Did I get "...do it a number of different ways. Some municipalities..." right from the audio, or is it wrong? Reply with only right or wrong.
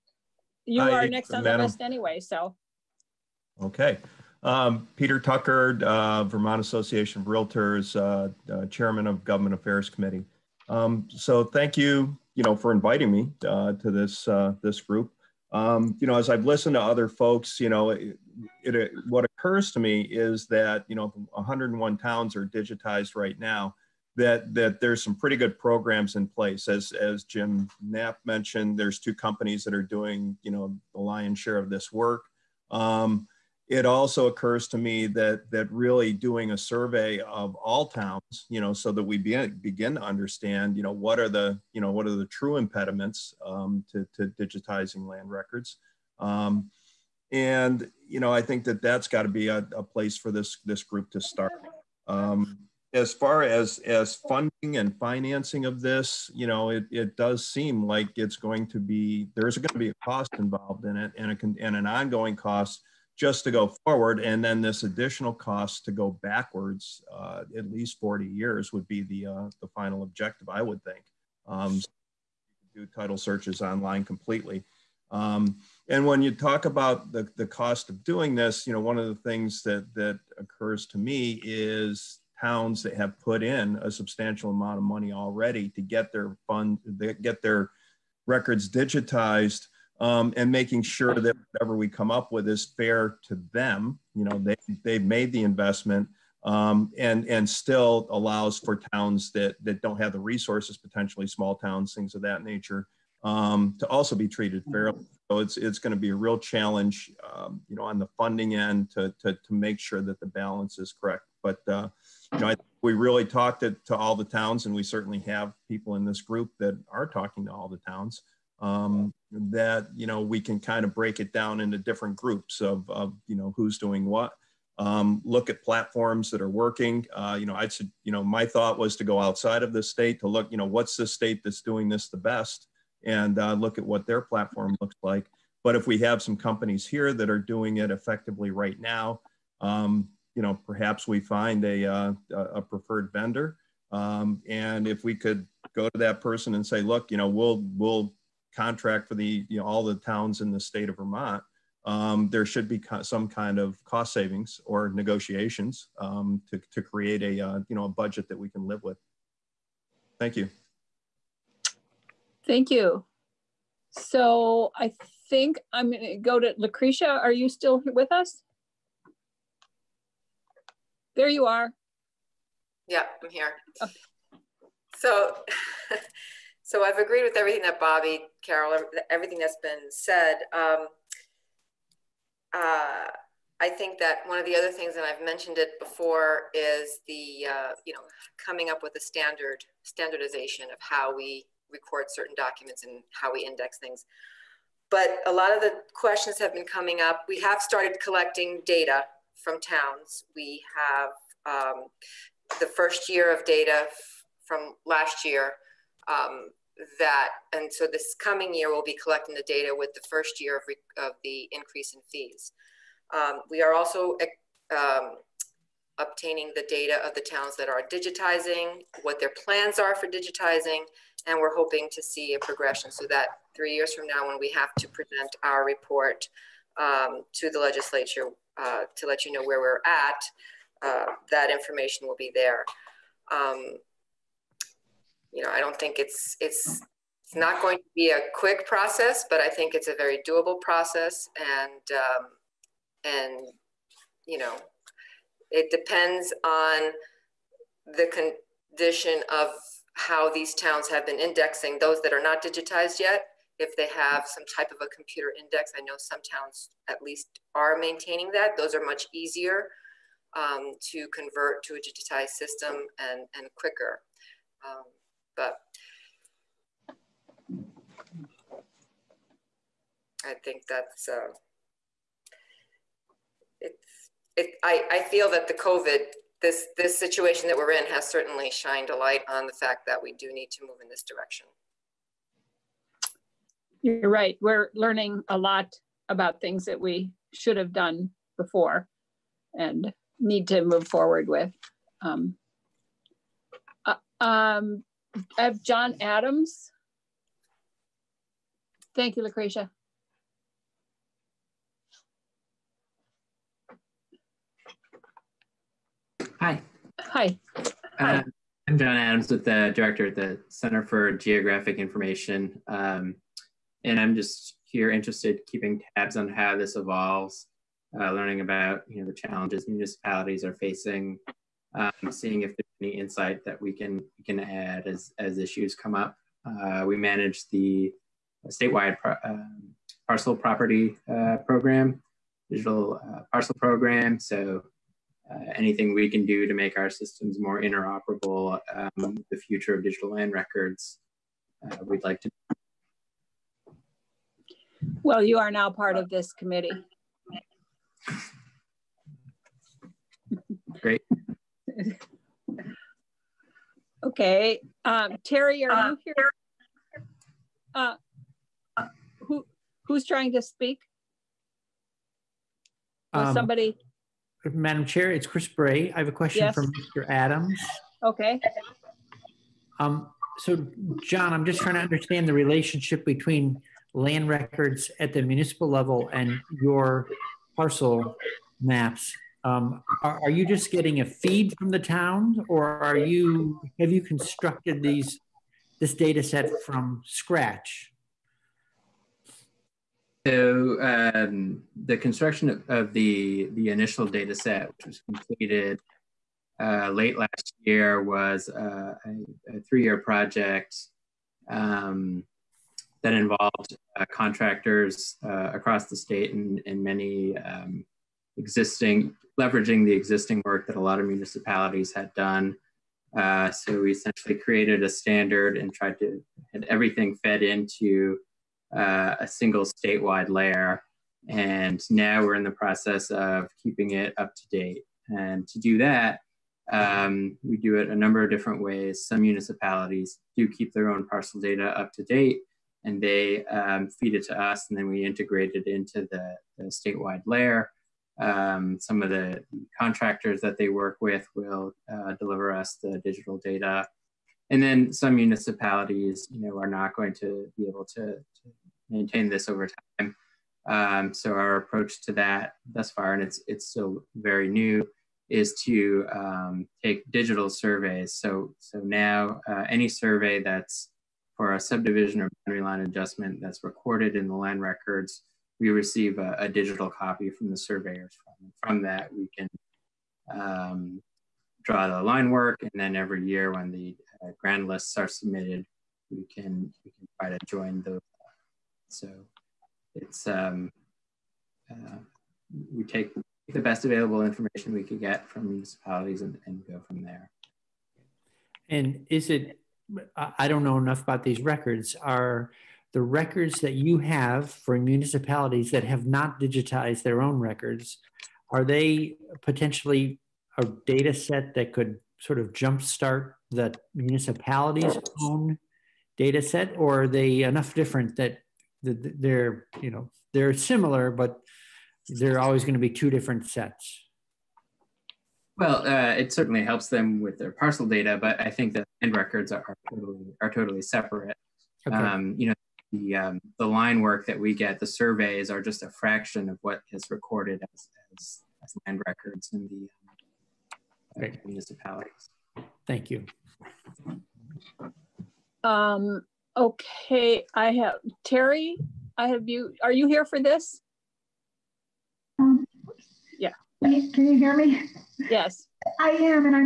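right.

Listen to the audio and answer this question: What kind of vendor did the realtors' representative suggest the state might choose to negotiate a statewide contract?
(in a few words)
preferred vendor.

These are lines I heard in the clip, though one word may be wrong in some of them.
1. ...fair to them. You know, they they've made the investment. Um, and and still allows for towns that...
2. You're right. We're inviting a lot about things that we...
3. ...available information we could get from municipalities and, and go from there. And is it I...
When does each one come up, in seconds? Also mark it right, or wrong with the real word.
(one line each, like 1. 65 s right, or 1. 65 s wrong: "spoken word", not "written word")
1. 92 s right
2. 283 s wrong: "learning", not "inviting"
3. 483 s right.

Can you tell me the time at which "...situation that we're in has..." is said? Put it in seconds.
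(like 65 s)
276 s.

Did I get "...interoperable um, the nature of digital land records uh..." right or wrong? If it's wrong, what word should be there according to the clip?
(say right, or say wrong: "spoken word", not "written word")
wrong: "future", not "nature".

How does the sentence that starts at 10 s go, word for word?
Um, so thank you, you know, for inviting me uh, to this uh, this group.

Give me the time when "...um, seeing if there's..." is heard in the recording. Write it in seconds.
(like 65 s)
321 s.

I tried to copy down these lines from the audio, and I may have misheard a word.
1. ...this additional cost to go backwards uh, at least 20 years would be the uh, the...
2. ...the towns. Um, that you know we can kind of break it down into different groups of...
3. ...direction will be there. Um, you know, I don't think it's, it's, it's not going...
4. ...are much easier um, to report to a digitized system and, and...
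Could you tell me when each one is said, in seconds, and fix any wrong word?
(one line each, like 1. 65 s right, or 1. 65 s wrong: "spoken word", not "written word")
1. 64 s wrong: "40", not "20"
2. 117 s right
3. 231 s wrong: "information", not "direction"
4. 258 s wrong: "convert", not "report".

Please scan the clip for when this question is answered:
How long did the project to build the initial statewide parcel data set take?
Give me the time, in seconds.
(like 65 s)
399 s.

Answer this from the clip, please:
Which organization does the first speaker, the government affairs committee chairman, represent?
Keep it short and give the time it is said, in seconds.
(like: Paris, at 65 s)
Vermont Association of Realtors, at 6 s.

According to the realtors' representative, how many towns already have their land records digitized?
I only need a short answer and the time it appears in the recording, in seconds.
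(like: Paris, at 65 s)
101, at 21 s.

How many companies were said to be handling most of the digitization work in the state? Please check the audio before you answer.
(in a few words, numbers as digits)
2.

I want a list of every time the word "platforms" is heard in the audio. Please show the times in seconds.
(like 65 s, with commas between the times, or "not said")
125 s, 134 s.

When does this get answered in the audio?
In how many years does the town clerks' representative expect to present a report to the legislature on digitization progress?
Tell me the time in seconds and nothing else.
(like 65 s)
223 s.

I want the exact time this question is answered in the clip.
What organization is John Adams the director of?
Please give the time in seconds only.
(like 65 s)
310 s.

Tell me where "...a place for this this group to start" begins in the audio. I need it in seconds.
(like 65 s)
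49 s.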